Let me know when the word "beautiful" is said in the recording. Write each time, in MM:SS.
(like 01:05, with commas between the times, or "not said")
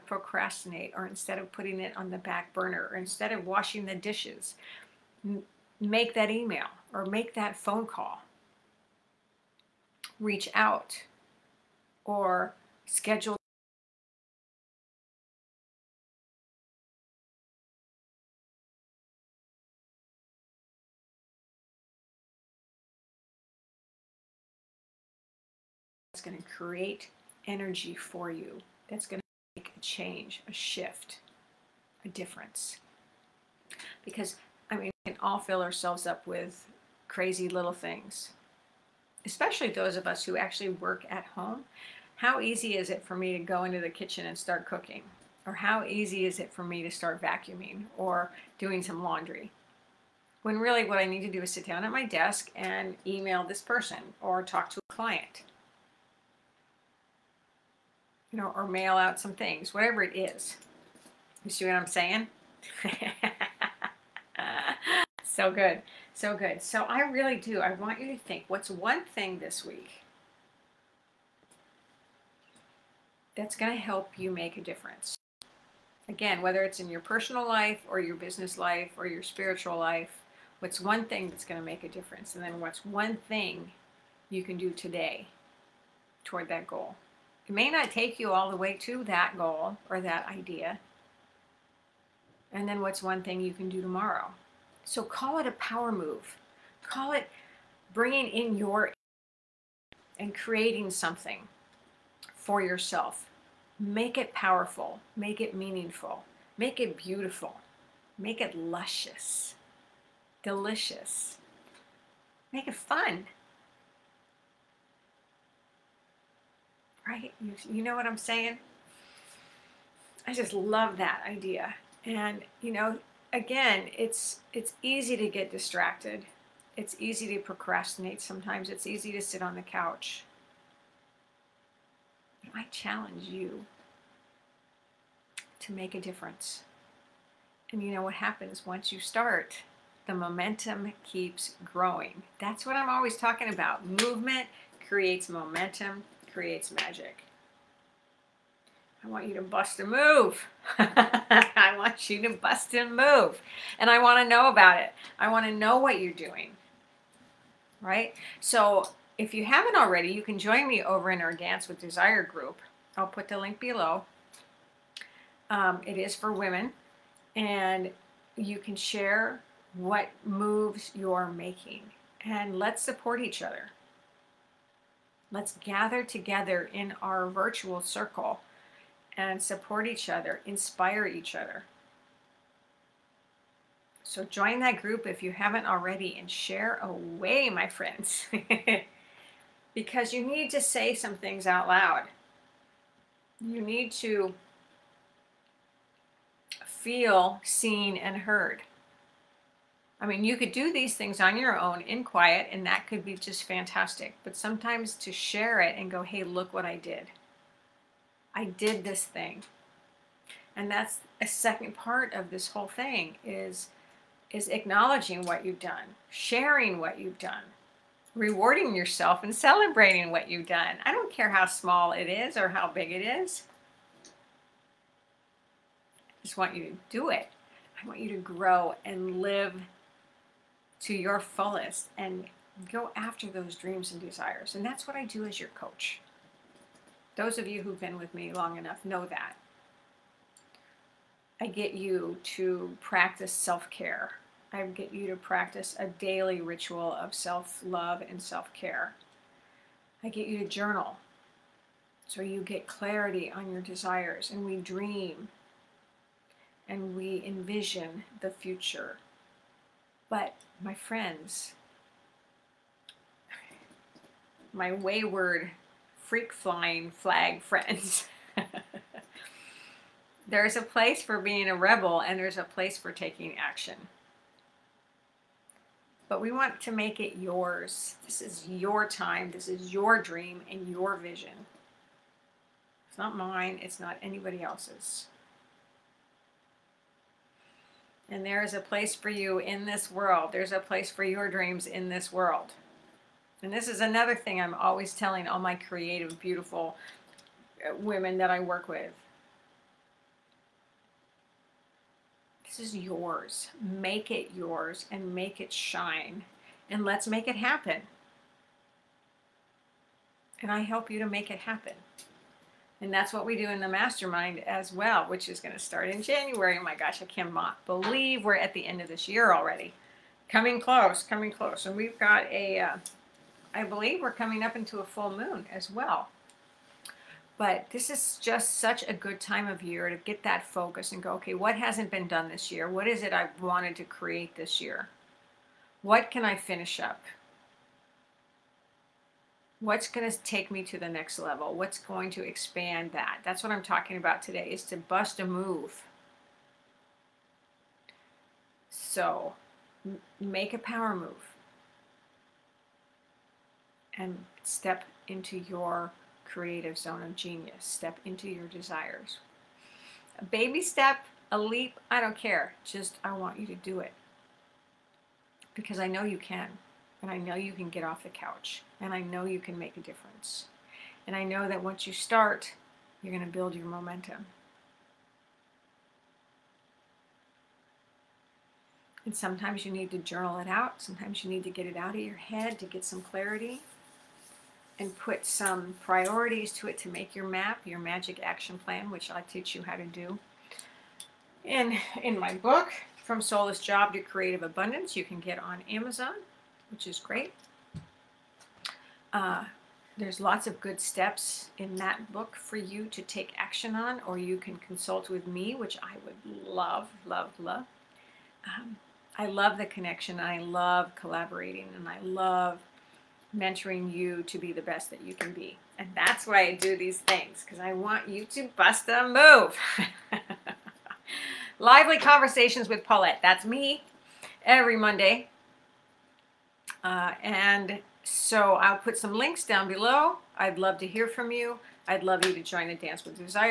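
01:46, 04:56.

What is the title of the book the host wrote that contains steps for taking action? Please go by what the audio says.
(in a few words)
From Soulless Job to Creative Abundance.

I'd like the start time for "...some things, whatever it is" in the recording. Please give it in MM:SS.
00:59.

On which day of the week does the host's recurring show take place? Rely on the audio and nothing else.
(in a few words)
Monday.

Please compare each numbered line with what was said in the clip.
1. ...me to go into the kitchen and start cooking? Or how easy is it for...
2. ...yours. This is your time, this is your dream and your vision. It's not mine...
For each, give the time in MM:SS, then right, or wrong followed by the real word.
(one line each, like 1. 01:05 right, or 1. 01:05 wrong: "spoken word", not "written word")
1. 00:43 right
2. 04:37 right.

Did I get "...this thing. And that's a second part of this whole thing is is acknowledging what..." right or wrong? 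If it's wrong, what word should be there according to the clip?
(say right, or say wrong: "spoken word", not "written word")
right.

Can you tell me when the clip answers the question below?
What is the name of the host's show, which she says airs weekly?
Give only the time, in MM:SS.
07:01.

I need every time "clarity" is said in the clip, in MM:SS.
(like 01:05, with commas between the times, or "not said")
04:12, 06:22.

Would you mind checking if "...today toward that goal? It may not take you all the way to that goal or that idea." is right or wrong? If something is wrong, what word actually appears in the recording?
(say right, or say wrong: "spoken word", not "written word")
right.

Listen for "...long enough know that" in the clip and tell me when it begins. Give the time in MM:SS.
03:58.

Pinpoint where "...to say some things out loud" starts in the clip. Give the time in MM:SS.
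03:10.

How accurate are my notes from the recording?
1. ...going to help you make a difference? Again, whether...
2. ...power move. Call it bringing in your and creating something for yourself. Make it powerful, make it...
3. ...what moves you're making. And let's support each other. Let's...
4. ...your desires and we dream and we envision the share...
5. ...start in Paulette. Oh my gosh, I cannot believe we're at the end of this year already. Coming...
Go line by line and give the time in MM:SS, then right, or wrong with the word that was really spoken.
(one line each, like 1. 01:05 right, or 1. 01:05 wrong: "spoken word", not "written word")
1. 01:13 right
2. 01:35 right
3. 02:49 right
4. 04:13 wrong: "future", not "share"
5. 05:15 wrong: "January", not "Paulette".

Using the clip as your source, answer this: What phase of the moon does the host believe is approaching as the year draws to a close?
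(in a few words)
full moon.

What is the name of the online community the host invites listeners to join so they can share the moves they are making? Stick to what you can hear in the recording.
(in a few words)
Dance with Desire.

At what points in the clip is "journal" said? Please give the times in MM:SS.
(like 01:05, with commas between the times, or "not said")
04:10, 06:19.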